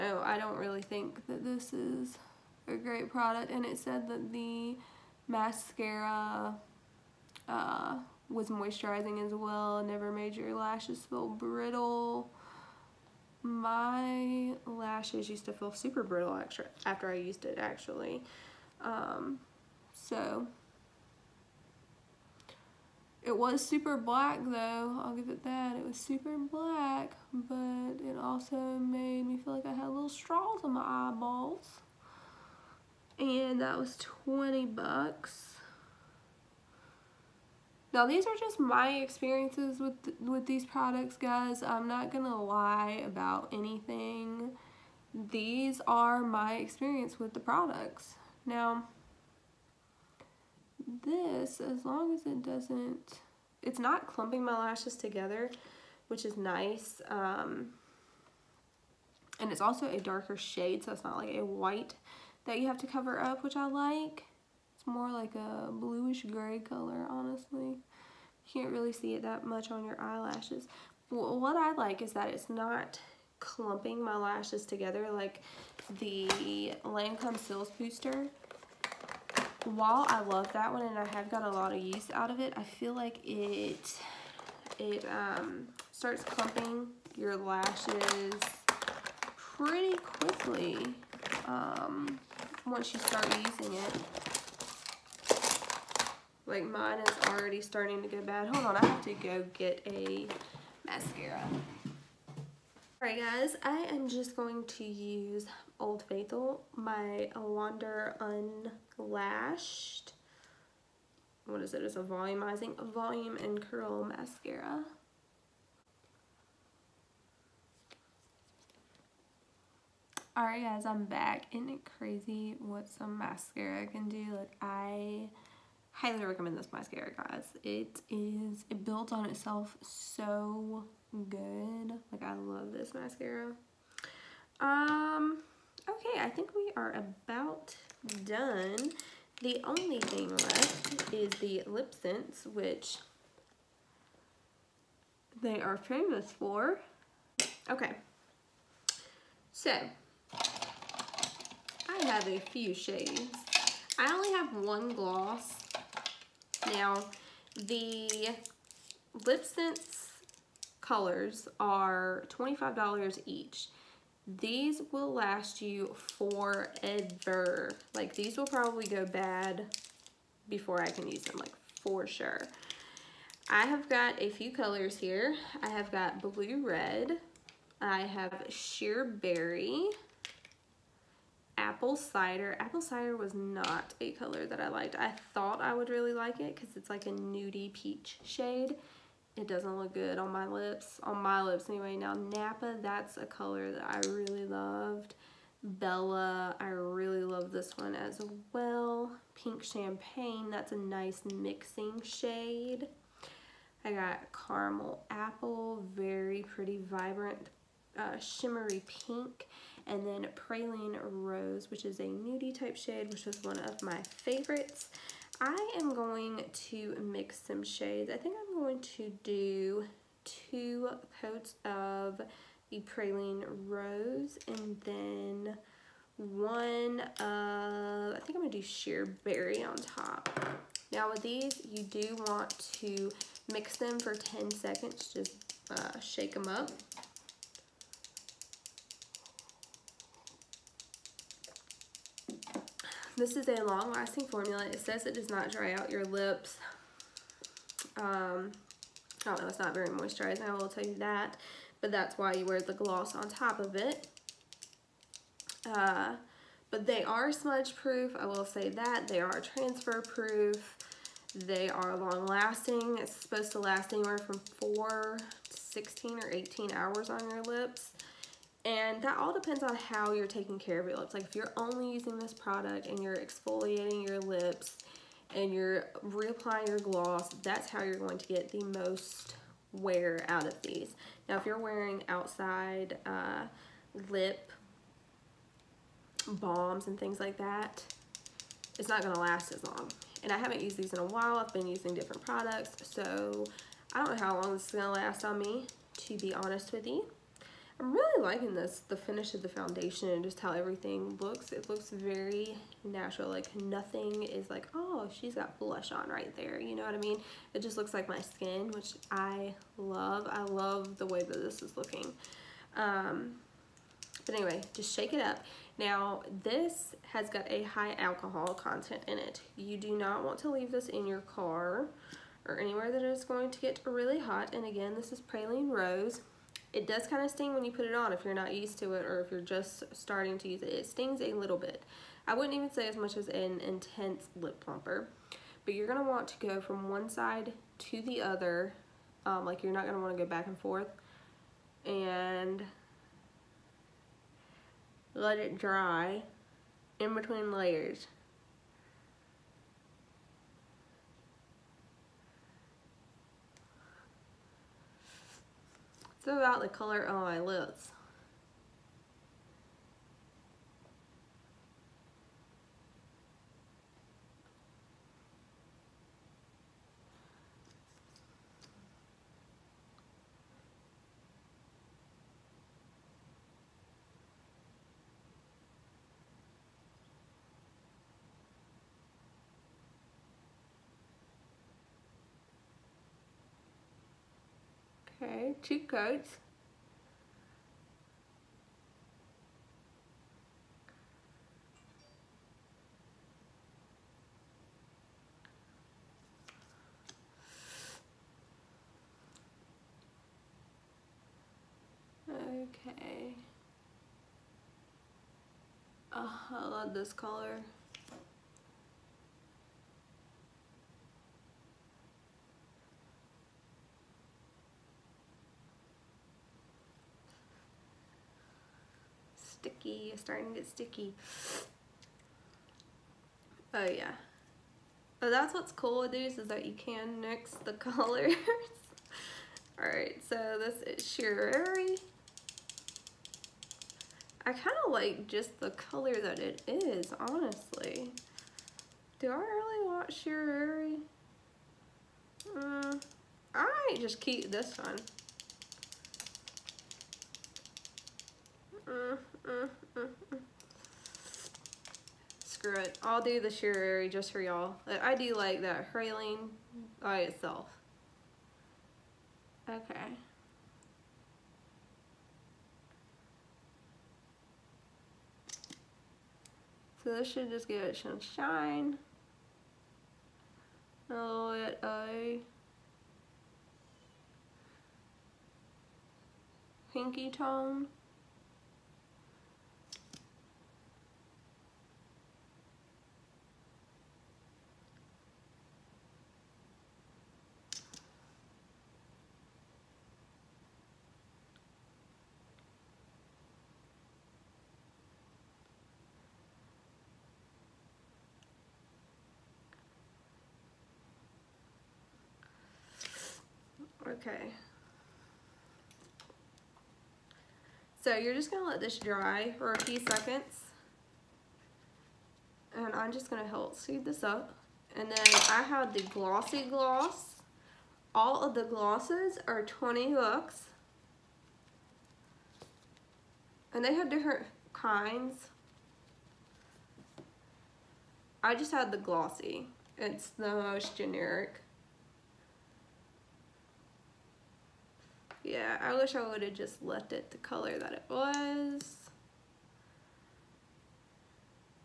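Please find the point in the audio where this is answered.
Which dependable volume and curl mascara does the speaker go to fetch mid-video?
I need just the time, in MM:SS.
01:47.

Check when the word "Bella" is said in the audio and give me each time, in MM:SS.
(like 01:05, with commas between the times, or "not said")
03:15.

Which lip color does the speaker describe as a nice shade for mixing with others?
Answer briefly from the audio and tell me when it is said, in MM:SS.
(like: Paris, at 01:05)
Pink Champagne, at 03:19.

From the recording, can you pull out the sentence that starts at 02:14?
Um, okay, I think we are about done.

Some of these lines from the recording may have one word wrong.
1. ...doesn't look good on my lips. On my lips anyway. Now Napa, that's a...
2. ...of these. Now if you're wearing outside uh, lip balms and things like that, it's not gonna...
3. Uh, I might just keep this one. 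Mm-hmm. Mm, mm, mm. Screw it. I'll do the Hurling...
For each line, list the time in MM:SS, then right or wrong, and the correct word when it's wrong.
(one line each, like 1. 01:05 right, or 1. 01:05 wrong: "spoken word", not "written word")
1. 03:09 right
2. 04:40 right
3. 07:22 wrong: "Sheer", not "Hurling".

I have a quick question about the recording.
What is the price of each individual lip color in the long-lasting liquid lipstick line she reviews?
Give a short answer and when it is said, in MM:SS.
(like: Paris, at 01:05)
$25, at 02:42.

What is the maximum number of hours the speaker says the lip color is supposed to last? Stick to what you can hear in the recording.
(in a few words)
18.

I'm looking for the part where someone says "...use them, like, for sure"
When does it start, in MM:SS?
02:51.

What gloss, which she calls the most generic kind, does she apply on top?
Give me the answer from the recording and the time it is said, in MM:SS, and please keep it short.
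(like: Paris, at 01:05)
Glossy Gloss, at 08:36.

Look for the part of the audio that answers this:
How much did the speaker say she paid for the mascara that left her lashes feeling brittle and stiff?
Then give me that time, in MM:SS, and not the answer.
00:34.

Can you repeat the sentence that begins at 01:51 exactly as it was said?
It's a volumizing volume and curl mascara.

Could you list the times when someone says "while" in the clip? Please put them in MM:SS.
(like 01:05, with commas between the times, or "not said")
01:19, 04:51.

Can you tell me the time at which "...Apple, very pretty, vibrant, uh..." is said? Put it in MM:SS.
03:25.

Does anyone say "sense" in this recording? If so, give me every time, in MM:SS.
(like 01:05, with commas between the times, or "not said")
02:21, 02:39.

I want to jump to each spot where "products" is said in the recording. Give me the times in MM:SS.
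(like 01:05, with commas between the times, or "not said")
00:03, 00:40, 00:47, 04:32, 04:52.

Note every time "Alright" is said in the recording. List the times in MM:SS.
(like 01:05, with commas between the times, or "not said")
01:43, 02:00, 07:09.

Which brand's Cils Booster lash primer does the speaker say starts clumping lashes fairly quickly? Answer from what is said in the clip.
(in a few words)
Lancome.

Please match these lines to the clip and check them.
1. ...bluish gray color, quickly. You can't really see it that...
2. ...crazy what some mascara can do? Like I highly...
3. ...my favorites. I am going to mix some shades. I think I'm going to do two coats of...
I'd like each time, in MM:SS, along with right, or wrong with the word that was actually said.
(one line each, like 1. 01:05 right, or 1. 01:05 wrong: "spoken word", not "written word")
1. 01:05 wrong: "honestly", not "quickly"
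2. 02:01 right
3. 03:33 right.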